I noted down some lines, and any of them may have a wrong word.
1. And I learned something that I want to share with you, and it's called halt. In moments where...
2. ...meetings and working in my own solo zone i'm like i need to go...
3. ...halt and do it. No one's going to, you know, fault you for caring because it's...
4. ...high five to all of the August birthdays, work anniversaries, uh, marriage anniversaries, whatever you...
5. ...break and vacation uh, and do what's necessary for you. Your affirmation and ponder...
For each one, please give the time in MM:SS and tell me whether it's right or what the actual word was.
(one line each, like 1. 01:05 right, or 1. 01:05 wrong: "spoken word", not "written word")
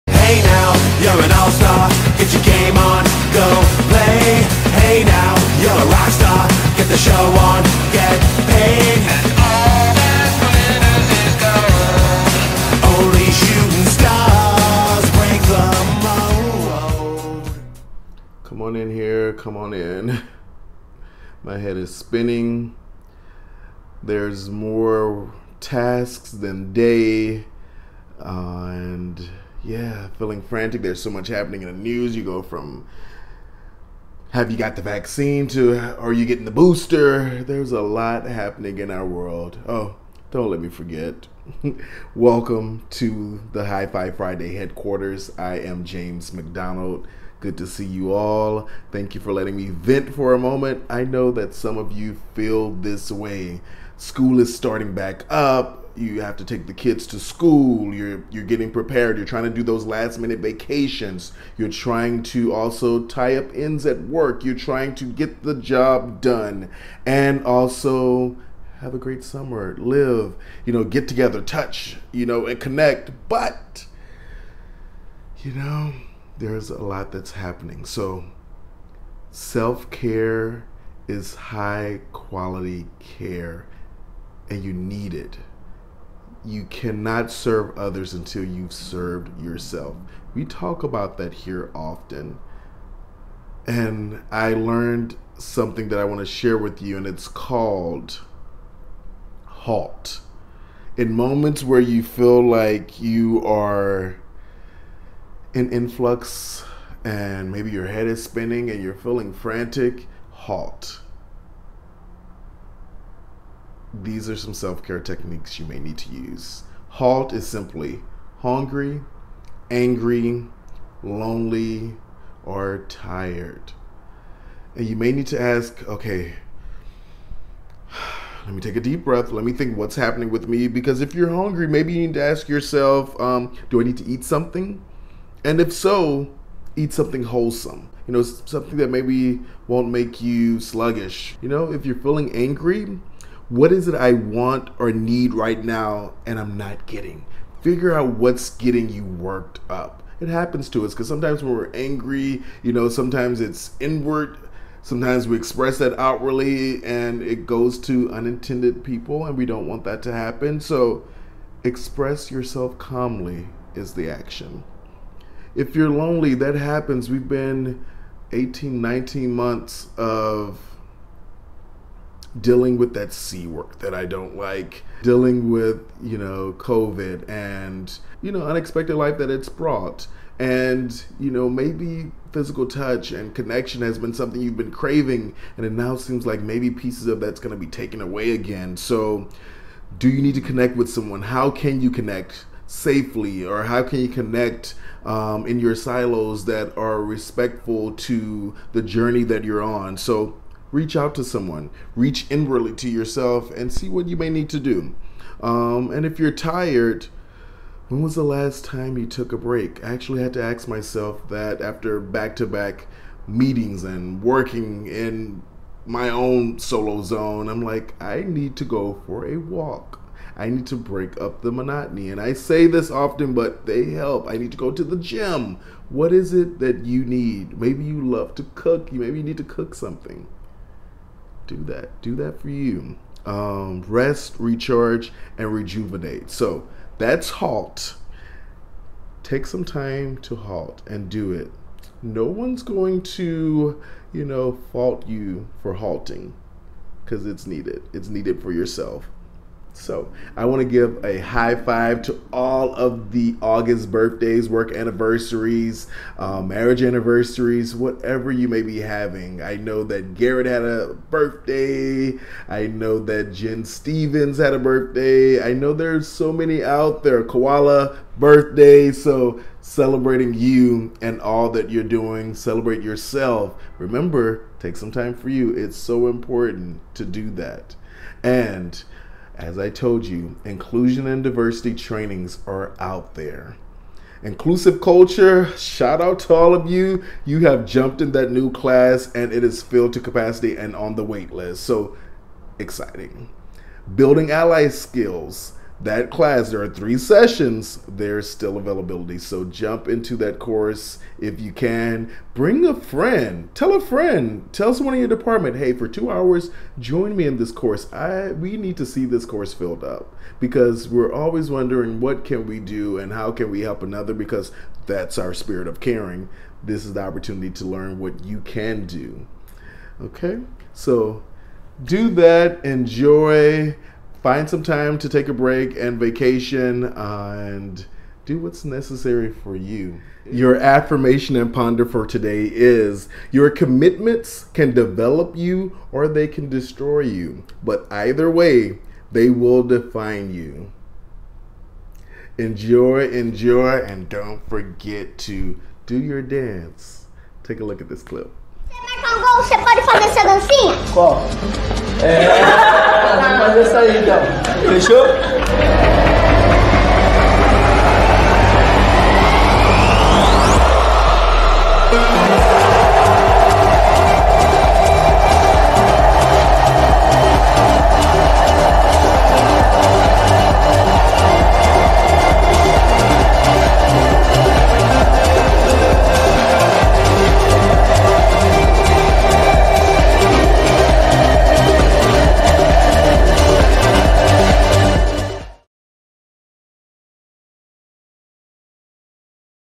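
1. 01:33 right
2. 03:33 right
3. 04:00 wrong: "halting", not "caring"
4. 04:11 right
5. 05:25 right.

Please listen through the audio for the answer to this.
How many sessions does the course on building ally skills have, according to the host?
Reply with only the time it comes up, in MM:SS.
04:56.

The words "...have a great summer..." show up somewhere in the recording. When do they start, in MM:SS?
01:08.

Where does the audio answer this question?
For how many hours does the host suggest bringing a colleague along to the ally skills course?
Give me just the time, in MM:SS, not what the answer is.
05:05.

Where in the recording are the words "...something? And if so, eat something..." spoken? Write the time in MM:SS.
02:14.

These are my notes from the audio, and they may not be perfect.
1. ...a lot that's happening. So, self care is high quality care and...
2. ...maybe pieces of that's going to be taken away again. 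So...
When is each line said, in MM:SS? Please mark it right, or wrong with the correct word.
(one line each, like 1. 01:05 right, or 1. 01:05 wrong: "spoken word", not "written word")
1. 01:16 right
2. 03:06 right.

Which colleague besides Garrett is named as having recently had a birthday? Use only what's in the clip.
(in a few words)
Jen Stevens.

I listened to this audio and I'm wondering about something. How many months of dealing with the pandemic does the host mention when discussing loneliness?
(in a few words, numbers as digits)
18, 19 months.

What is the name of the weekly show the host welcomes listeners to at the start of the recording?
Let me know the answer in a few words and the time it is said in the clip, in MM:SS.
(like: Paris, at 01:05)
High Five Friday, at 00:43.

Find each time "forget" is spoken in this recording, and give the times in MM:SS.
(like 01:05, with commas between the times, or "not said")
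00:40, 05:44.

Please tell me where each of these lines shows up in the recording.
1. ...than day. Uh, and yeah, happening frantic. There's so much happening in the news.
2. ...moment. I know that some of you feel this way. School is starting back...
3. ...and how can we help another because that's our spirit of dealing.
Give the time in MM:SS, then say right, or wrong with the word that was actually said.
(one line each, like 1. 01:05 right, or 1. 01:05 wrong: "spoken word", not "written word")
1. 00:26 wrong: "feeling", not "happening"
2. 00:50 right
3. 05:12 wrong: "caring", not "dealing".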